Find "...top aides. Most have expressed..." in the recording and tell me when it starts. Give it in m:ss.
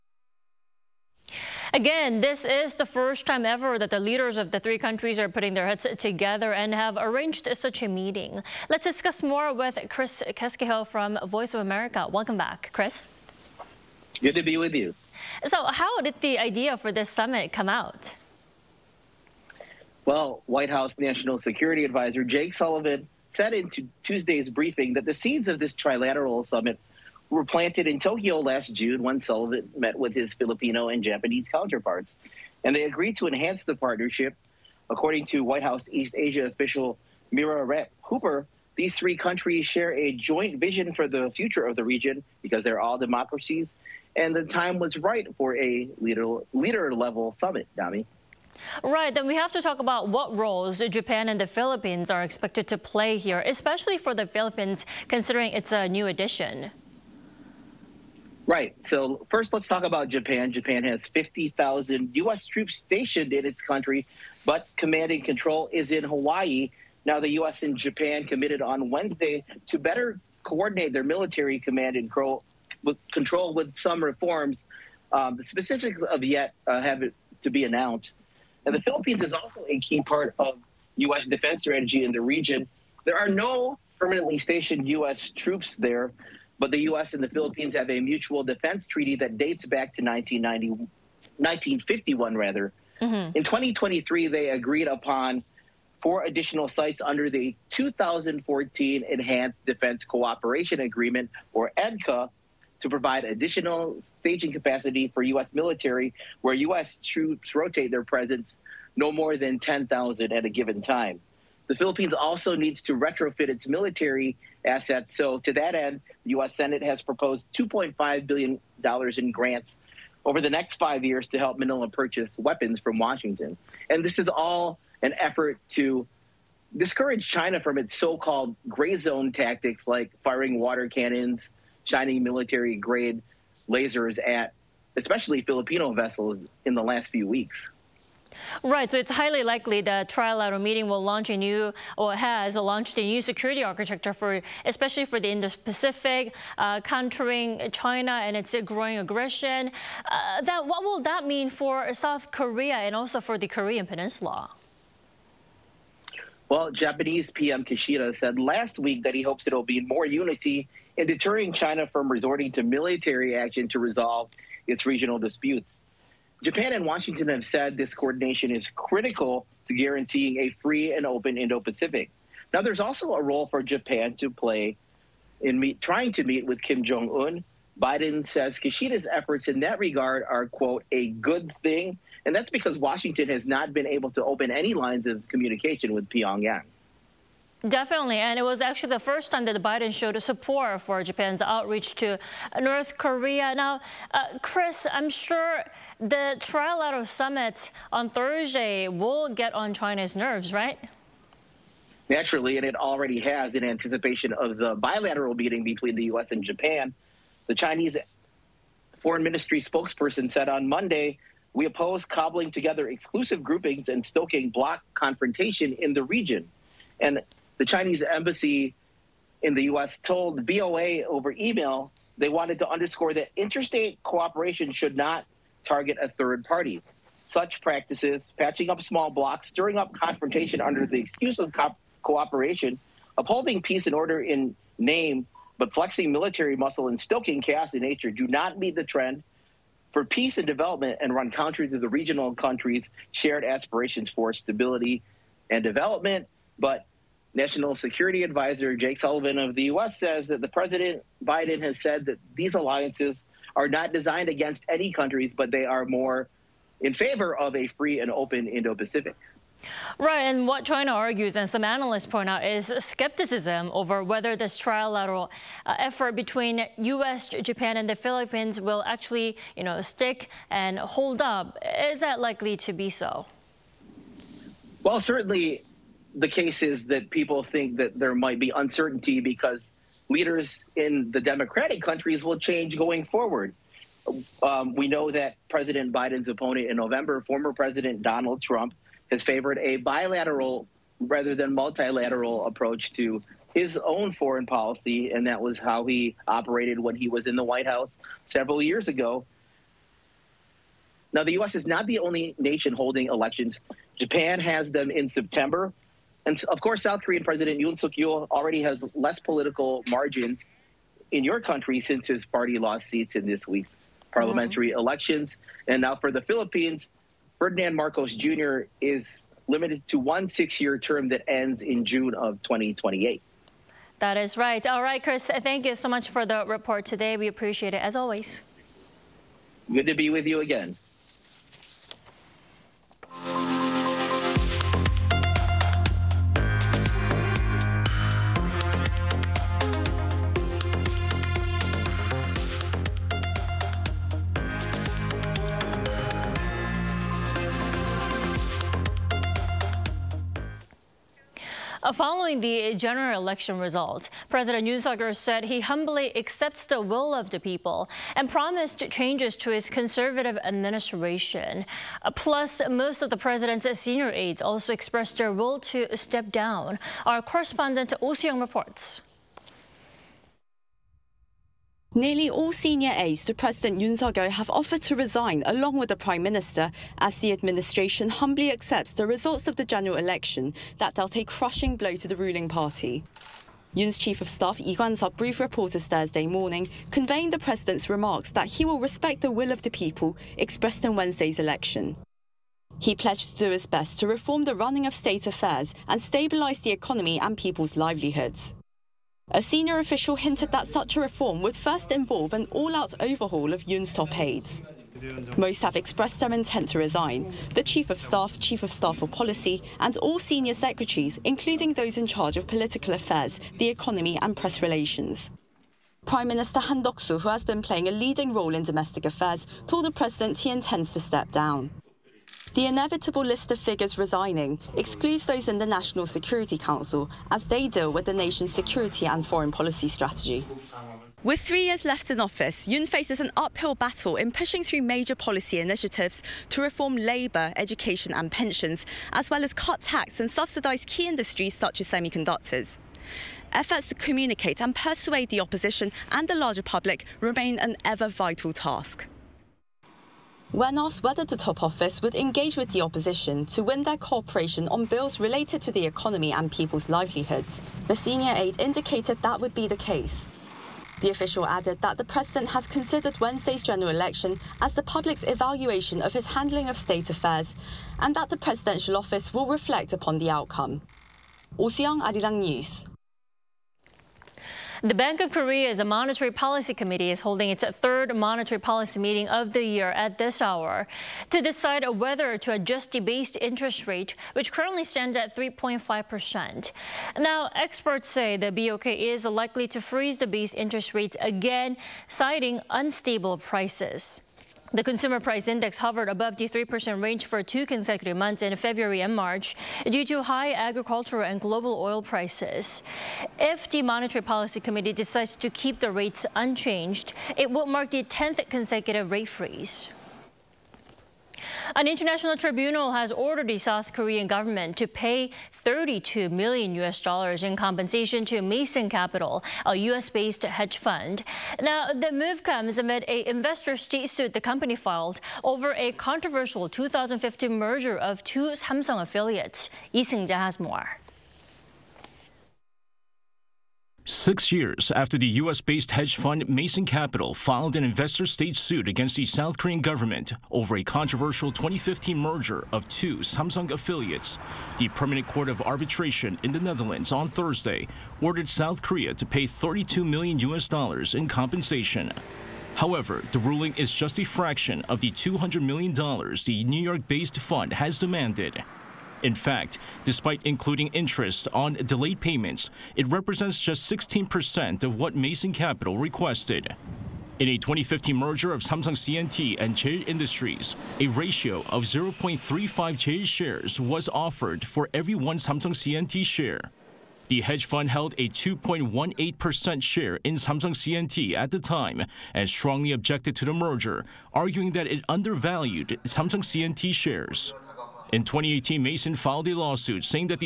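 6:43.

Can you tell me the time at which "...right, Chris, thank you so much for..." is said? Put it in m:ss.
5:24.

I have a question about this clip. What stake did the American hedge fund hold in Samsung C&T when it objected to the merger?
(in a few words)
2.18%.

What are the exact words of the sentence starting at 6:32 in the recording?
He pledged to do his best to reform the running of state affairs and stabilise the economy and people's livelihoods.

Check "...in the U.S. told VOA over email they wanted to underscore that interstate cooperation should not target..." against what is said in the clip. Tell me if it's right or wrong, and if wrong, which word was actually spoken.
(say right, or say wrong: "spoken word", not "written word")
right.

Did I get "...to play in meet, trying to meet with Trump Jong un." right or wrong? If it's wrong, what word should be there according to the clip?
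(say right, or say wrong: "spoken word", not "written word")
wrong: "Kim", not "Trump".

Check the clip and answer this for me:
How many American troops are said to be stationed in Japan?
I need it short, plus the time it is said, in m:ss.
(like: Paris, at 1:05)
50,000, at 1:01.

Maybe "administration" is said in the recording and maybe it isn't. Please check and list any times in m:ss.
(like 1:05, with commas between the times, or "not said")
6:00, 6:17.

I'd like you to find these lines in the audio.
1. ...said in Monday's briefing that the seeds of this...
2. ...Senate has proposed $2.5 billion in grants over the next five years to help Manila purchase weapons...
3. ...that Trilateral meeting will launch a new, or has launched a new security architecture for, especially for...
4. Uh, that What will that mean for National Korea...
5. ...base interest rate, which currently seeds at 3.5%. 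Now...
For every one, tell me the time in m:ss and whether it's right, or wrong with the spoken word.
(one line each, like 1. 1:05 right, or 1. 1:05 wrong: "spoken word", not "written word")
1. 0:23 wrong: "Tuesday", not "Monday"
2. 1:56 right
3. 2:19 right
4. 2:30 wrong: "South", not "National"
5. 8:03 wrong: "stands", not "seeds".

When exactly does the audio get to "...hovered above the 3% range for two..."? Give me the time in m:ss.
8:15.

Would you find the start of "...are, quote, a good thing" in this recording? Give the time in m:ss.
3:00.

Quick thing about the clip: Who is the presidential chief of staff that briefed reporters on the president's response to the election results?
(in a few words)
Lee Kwan-sup.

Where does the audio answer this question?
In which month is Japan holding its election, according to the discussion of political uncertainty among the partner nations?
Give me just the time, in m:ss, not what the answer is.
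5:05.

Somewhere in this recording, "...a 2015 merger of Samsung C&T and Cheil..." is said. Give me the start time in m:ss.
9:27.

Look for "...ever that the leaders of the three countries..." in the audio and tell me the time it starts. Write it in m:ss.
0:03.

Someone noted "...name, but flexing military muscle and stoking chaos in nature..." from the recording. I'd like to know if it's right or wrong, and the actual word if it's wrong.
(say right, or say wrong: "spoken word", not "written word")
right.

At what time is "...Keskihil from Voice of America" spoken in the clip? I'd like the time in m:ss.
0:10.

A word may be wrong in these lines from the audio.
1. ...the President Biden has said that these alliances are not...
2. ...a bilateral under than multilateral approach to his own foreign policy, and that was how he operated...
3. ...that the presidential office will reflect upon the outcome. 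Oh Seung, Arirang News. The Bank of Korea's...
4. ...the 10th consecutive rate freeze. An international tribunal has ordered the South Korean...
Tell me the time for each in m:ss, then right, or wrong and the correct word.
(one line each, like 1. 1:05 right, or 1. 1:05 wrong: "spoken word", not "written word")
1. 4:10 right
2. 4:49 wrong: "rather", not "under"
3. 7:48 right
4. 8:27 right.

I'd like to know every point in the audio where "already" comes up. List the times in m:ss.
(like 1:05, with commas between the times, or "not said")
3:22, 5:08.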